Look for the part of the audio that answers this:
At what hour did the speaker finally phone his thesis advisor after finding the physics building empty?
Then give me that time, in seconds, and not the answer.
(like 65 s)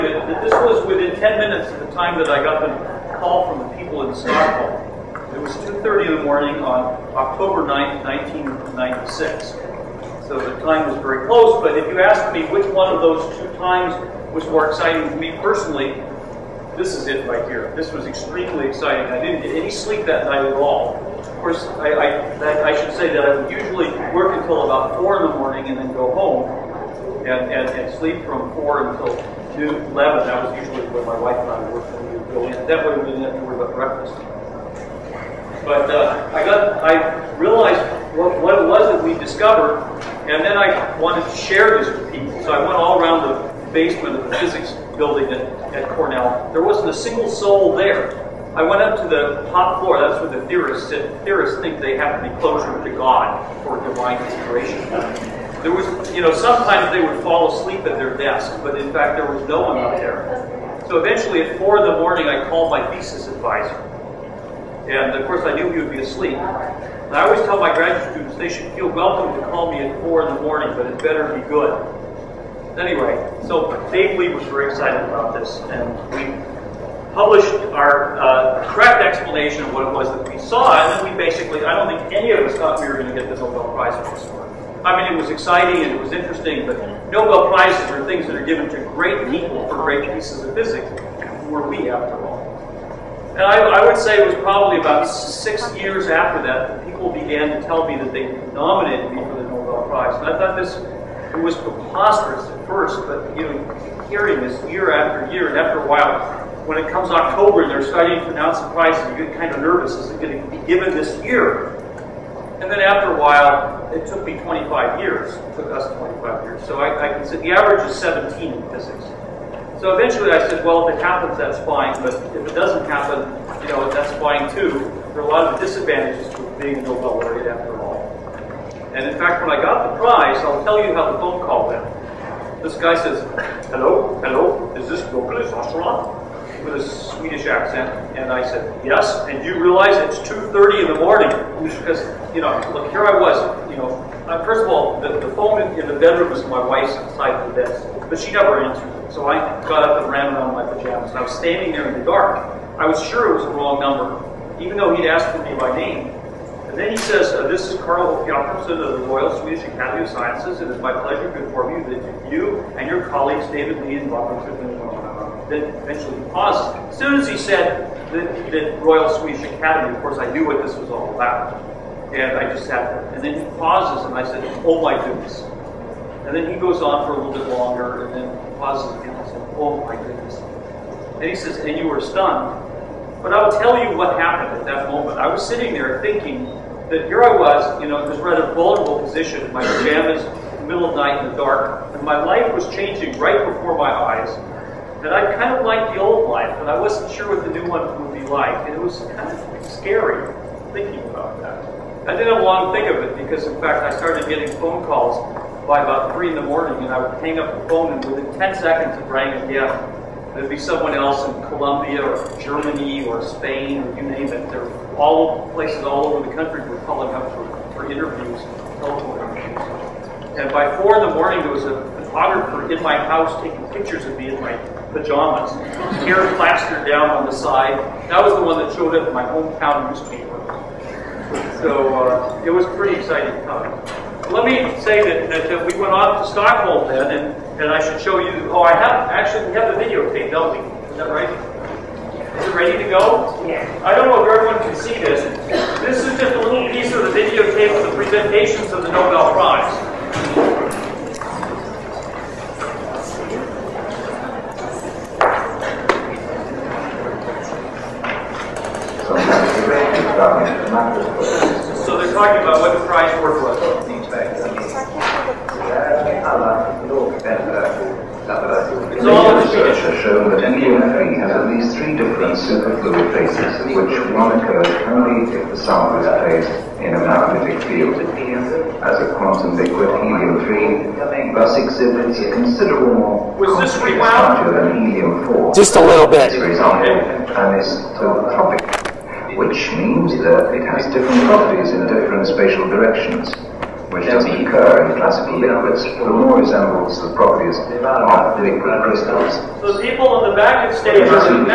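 61 s.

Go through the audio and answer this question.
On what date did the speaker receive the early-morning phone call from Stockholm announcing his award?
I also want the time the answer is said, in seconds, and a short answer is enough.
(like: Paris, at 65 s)
October 9th, 1996, at 7 s.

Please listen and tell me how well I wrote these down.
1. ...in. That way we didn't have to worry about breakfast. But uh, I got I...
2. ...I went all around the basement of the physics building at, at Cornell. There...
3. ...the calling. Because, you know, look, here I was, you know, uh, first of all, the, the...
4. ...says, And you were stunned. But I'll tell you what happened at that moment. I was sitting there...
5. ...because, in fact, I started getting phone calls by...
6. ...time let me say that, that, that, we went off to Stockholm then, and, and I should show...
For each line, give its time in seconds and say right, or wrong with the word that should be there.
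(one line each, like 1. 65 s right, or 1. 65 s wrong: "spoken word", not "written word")
1. 32 s right
2. 42 s right
3. 140 s wrong: "morning", not "calling"
4. 181 s right
5. 203 s right
6. 233 s right.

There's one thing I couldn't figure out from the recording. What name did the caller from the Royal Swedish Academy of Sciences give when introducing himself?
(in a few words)
Carl Jakobsen.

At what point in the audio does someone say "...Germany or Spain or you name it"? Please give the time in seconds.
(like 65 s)
212 s.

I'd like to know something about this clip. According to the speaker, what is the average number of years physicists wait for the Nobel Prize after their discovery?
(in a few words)
17.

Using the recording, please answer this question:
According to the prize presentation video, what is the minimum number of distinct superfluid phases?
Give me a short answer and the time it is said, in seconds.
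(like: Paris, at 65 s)
3, at 271 s.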